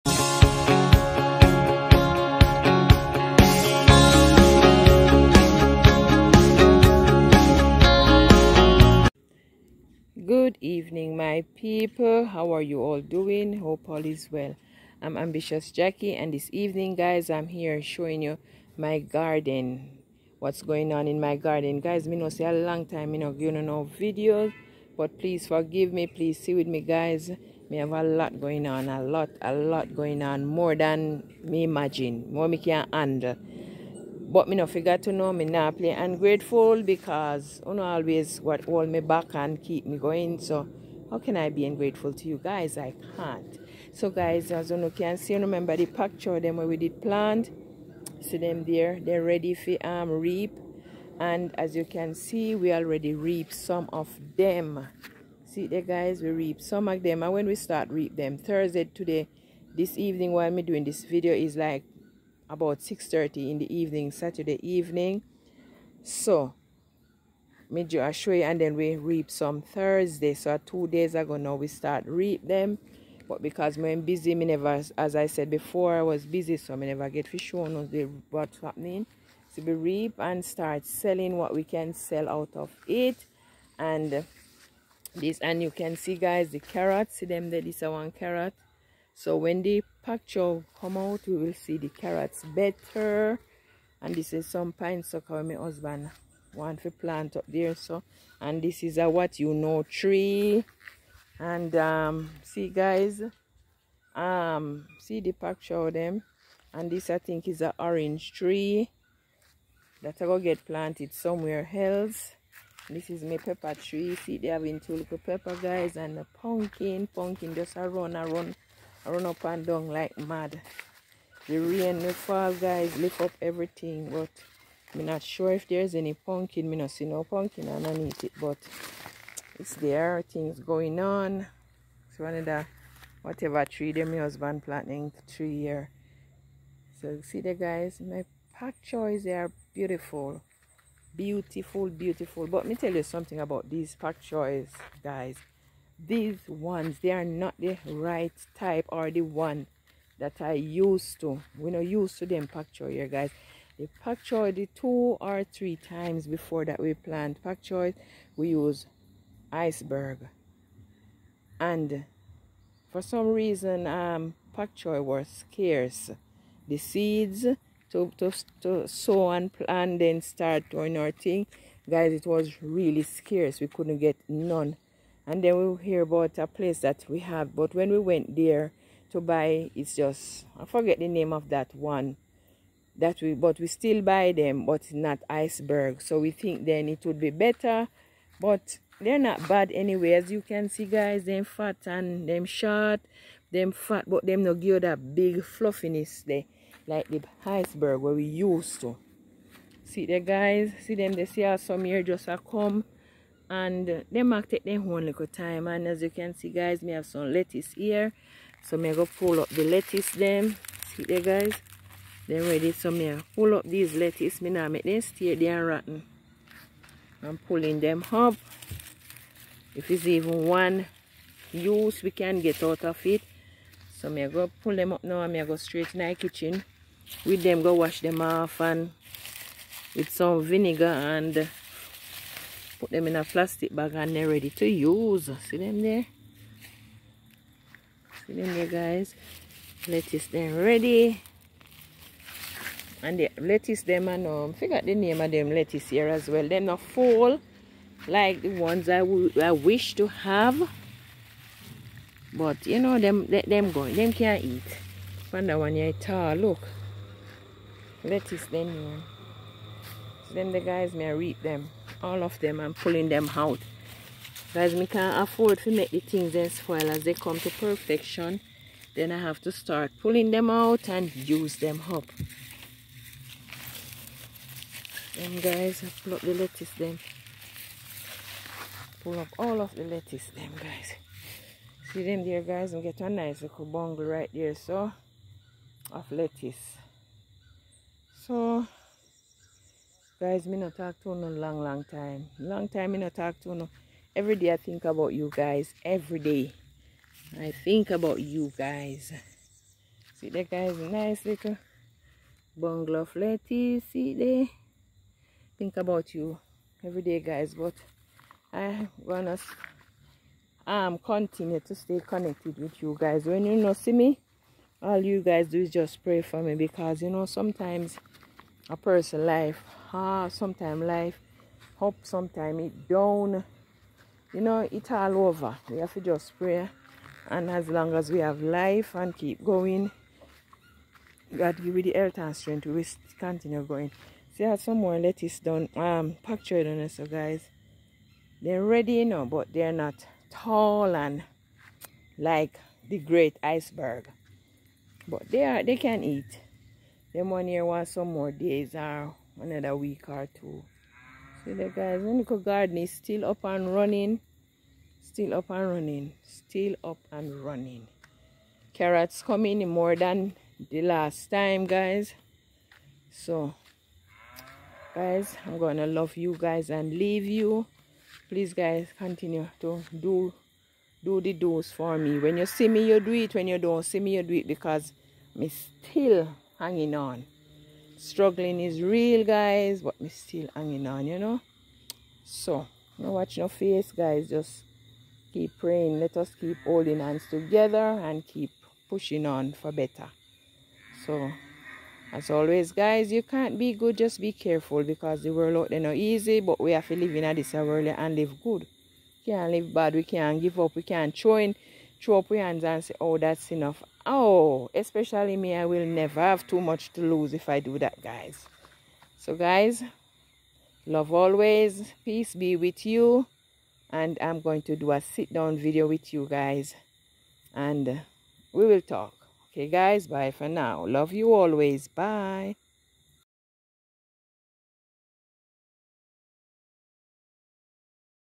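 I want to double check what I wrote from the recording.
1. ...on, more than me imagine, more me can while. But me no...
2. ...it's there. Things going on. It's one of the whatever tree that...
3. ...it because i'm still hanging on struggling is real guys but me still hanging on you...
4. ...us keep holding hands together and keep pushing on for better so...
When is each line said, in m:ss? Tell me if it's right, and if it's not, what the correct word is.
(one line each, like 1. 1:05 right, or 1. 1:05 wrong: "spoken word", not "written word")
1. 0:30 wrong: "handle", not "while"
2. 2:09 right
3. 6:14 right
4. 6:26 right.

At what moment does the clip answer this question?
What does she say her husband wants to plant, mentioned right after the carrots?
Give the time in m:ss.
1:34.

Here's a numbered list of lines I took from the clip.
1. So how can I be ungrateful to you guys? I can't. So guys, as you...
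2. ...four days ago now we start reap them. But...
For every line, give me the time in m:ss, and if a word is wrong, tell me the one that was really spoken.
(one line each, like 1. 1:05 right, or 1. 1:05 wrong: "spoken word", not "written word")
1. 0:40 right
2. 1:10 wrong: "two", not "four".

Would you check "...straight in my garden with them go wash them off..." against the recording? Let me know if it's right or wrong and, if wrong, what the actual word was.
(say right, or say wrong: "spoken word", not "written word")
wrong: "kitchen", not "garden".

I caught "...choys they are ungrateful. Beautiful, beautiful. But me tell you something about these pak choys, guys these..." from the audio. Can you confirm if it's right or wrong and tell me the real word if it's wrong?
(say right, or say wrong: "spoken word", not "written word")
wrong: "beautiful", not "ungrateful".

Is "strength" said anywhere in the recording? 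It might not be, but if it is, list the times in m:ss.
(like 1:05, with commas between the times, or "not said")
5:32.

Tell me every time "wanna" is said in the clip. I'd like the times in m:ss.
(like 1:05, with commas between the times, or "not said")
5:09.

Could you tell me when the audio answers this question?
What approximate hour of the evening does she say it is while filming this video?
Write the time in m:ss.
1:02.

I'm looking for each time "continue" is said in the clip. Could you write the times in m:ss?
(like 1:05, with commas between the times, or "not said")
5:10, 5:33, 6:08.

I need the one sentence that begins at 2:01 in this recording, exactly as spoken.
The rain, the fall, guys, lift up everything.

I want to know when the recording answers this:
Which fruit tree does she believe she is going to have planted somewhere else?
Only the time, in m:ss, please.
1:47.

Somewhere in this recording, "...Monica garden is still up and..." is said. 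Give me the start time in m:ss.
5:52.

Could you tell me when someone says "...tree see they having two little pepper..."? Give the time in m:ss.
1:53.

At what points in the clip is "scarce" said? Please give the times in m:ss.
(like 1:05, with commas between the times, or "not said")
2:45, 2:53.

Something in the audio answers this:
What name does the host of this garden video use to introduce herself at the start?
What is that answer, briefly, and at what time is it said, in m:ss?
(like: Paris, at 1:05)
Ambitious Jackie, at 0:15.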